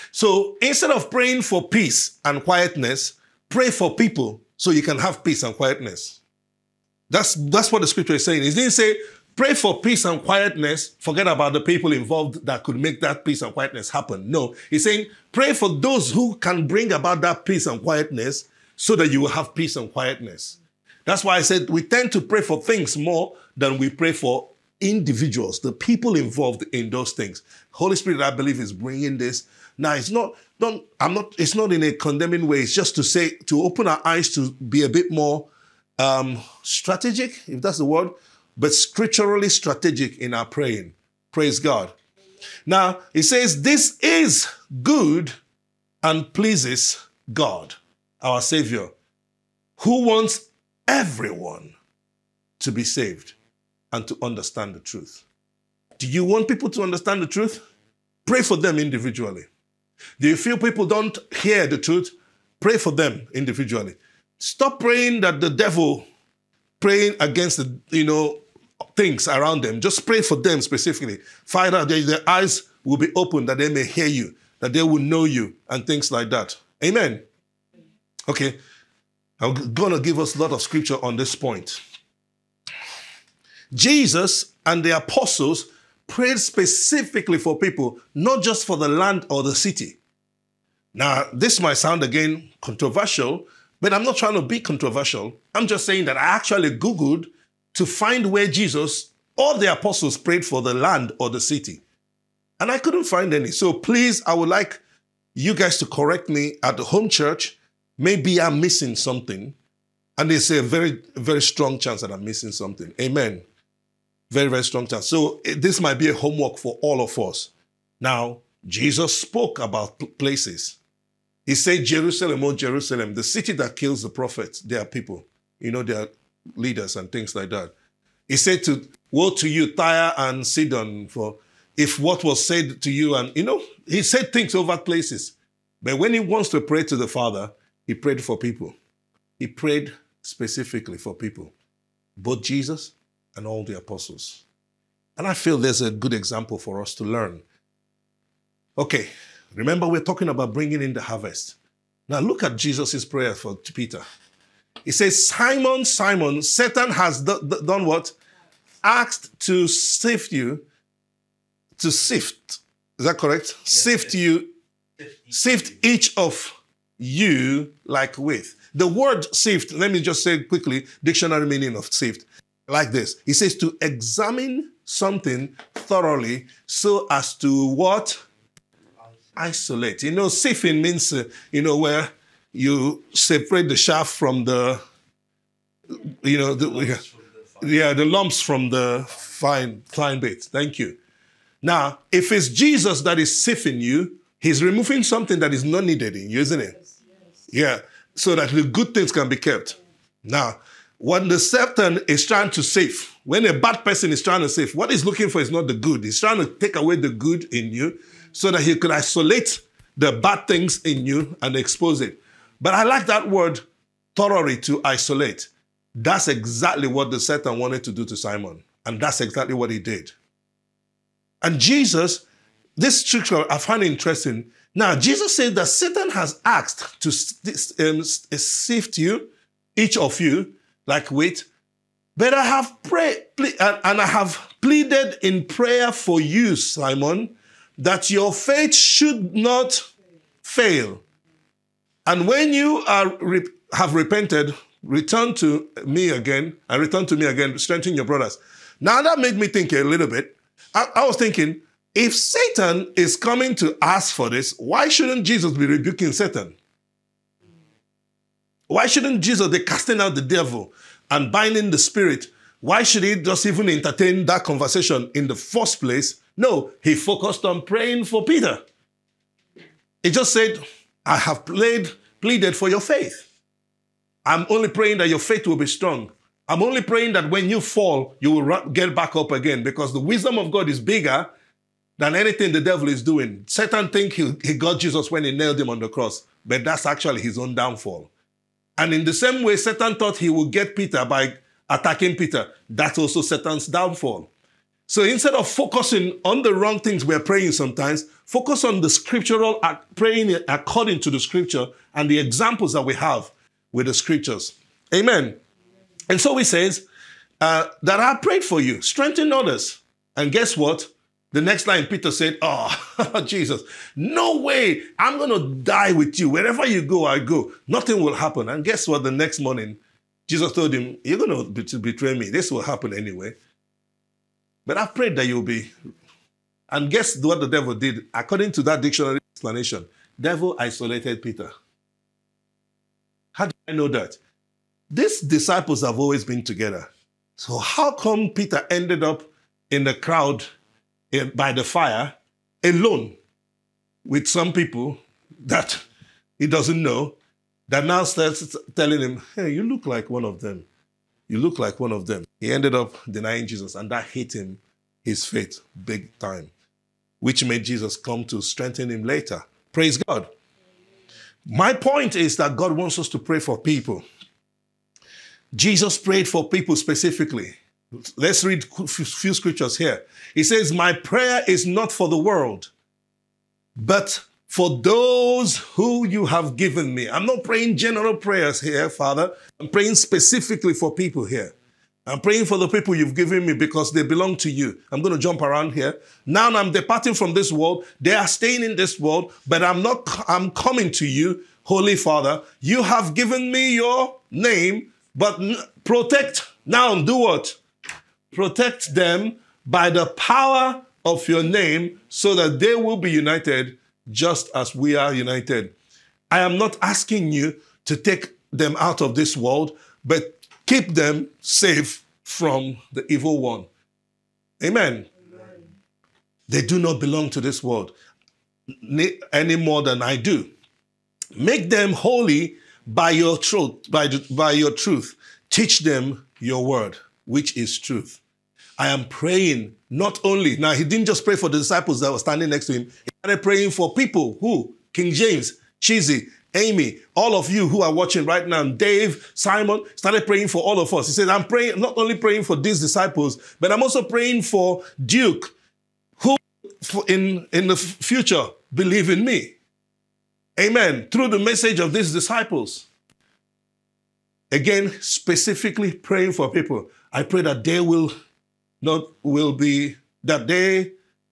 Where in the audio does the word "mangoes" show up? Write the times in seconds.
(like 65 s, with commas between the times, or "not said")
not said.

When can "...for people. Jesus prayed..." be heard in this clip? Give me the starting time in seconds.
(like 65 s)
363 s.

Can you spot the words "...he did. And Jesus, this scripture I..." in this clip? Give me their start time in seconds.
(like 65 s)
219 s.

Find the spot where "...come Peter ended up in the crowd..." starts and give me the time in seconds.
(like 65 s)
337 s.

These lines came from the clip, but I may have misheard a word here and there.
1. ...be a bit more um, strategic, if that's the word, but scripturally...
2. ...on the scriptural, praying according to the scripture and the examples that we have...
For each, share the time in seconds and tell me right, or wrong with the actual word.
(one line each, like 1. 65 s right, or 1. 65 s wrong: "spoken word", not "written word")
1. 34 s right
2. 298 s right.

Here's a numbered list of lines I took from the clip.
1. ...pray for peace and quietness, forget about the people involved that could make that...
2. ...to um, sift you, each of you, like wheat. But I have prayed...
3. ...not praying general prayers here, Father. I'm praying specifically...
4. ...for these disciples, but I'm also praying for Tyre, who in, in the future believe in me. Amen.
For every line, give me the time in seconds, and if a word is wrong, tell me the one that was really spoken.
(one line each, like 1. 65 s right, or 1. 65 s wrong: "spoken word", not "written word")
1. 9 s right
2. 227 s right
3. 377 s right
4. 442 s wrong: "Duke", not "Tyre".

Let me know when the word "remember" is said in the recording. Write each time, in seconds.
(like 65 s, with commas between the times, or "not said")
149 s.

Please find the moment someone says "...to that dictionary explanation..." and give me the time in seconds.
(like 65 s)
328 s.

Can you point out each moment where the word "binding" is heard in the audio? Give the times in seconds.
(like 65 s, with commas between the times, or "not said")
261 s.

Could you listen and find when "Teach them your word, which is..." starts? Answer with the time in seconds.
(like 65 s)
425 s.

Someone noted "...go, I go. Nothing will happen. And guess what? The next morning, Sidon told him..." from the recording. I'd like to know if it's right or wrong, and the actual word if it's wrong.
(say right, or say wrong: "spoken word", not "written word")
wrong: "Jesus", not "Sidon".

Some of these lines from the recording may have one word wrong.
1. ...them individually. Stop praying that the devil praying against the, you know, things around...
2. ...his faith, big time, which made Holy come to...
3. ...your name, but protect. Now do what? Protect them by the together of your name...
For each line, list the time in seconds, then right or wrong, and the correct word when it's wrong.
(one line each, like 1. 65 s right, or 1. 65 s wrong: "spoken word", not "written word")
1. 62 s right
2. 355 s wrong: "Jesus", not "Holy"
3. 393 s wrong: "power", not "together".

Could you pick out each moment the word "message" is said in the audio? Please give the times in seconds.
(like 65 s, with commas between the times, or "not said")
451 s.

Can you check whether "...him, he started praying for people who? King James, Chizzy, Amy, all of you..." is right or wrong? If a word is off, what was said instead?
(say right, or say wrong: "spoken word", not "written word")
right.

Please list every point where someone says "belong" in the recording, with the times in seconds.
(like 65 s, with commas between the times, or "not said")
384 s, 416 s.